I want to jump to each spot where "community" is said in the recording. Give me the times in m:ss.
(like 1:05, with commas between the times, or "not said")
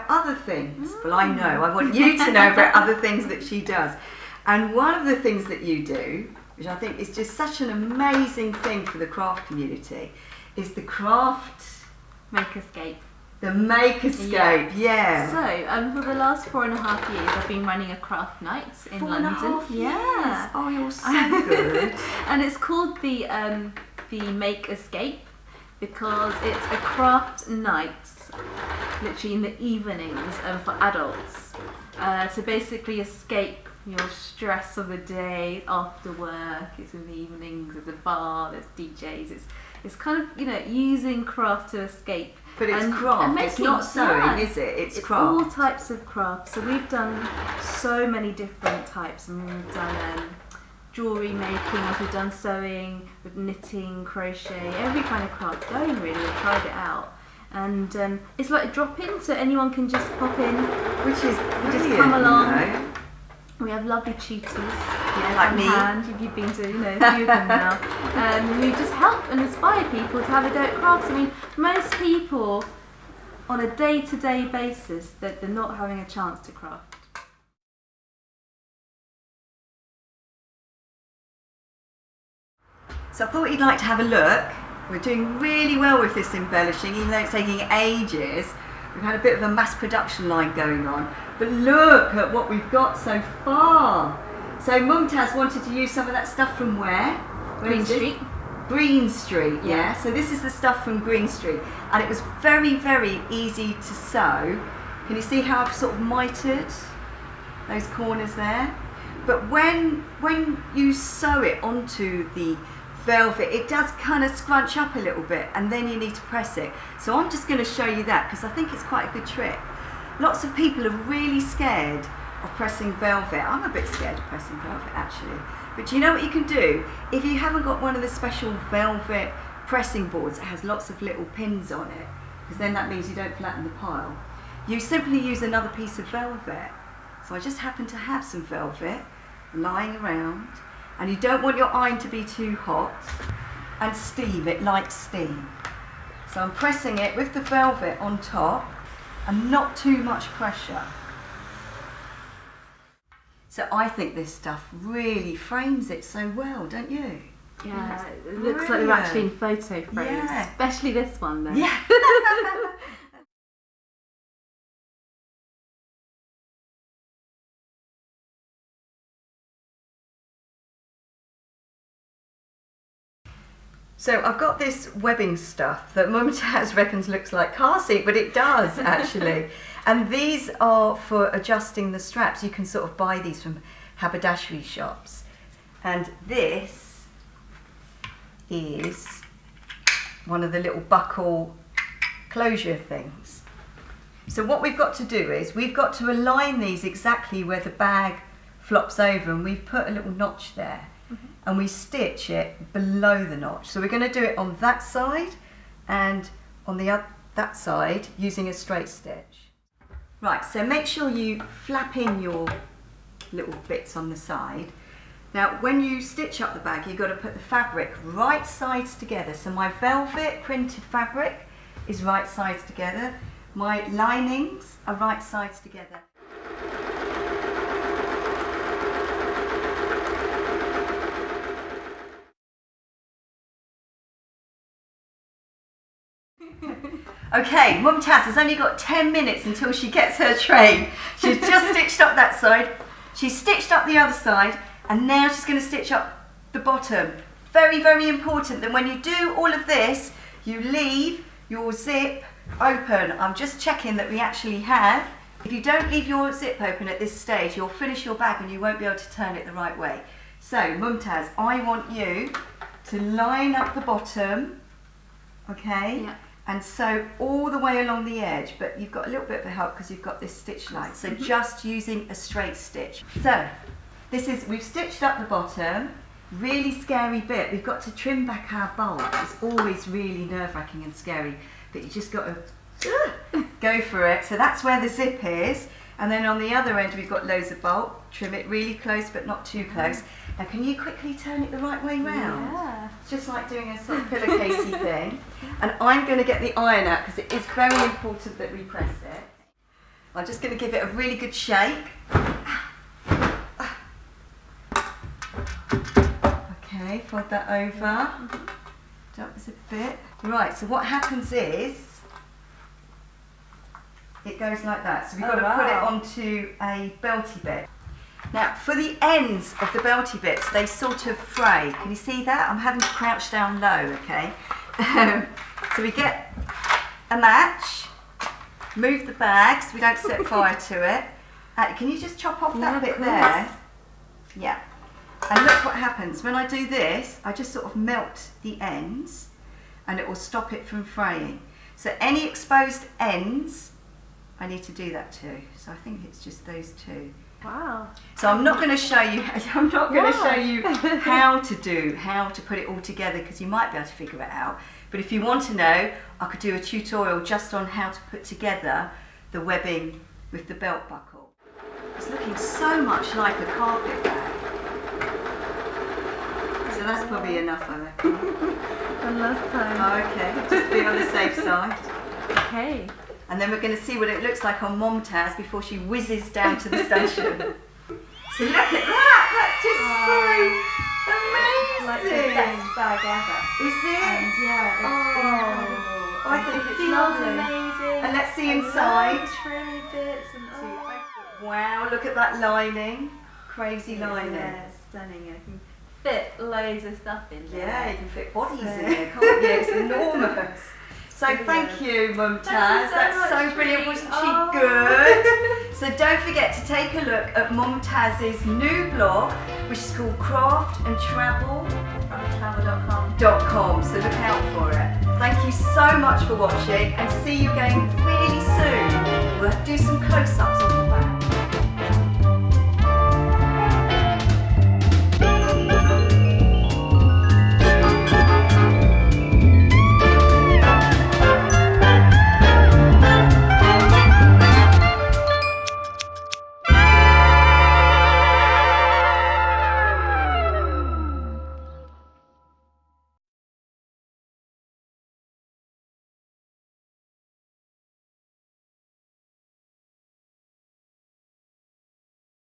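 0:09.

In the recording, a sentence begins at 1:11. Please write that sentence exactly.
I mean, most people on a day-to-day -day basis that they're not having a chance to craft.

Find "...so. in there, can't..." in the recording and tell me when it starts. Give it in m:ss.
6:38.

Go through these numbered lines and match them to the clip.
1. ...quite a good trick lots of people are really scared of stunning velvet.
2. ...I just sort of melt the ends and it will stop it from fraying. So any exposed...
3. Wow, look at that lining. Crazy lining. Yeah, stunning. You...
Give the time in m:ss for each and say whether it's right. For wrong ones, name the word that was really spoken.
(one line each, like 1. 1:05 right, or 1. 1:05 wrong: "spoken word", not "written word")
1. 1:58 wrong: "pressing", not "stunning"
2. 5:37 right
3. 6:31 right.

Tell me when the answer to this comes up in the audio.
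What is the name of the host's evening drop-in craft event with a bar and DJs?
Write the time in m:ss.
0:24.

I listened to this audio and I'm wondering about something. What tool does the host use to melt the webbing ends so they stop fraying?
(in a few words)
a match.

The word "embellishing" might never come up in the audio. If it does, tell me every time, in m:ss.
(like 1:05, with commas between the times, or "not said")
1:26.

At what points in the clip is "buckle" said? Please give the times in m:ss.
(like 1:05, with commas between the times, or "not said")
3:10, 6:00.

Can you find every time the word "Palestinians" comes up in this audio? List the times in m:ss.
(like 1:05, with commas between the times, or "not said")
not said.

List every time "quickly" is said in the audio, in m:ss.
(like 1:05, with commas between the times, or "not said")
4:50.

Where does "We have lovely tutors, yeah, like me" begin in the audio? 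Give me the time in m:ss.
1:03.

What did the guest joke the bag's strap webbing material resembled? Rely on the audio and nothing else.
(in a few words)
car seat.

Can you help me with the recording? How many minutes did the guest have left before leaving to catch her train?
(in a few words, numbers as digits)
10.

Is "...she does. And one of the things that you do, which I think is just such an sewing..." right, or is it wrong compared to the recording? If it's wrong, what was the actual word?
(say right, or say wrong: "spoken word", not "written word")
wrong: "amazing", not "sewing".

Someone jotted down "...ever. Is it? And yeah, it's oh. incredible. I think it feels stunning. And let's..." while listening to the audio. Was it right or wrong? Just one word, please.
wrong.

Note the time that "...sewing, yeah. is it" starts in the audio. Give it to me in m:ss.
0:43.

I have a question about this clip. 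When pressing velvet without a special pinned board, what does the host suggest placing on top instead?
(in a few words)
another piece of velvet.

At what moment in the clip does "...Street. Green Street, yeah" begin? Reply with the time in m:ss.
1:37.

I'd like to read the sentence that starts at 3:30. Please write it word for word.
Right, so make sure you flap in your little bits on the side.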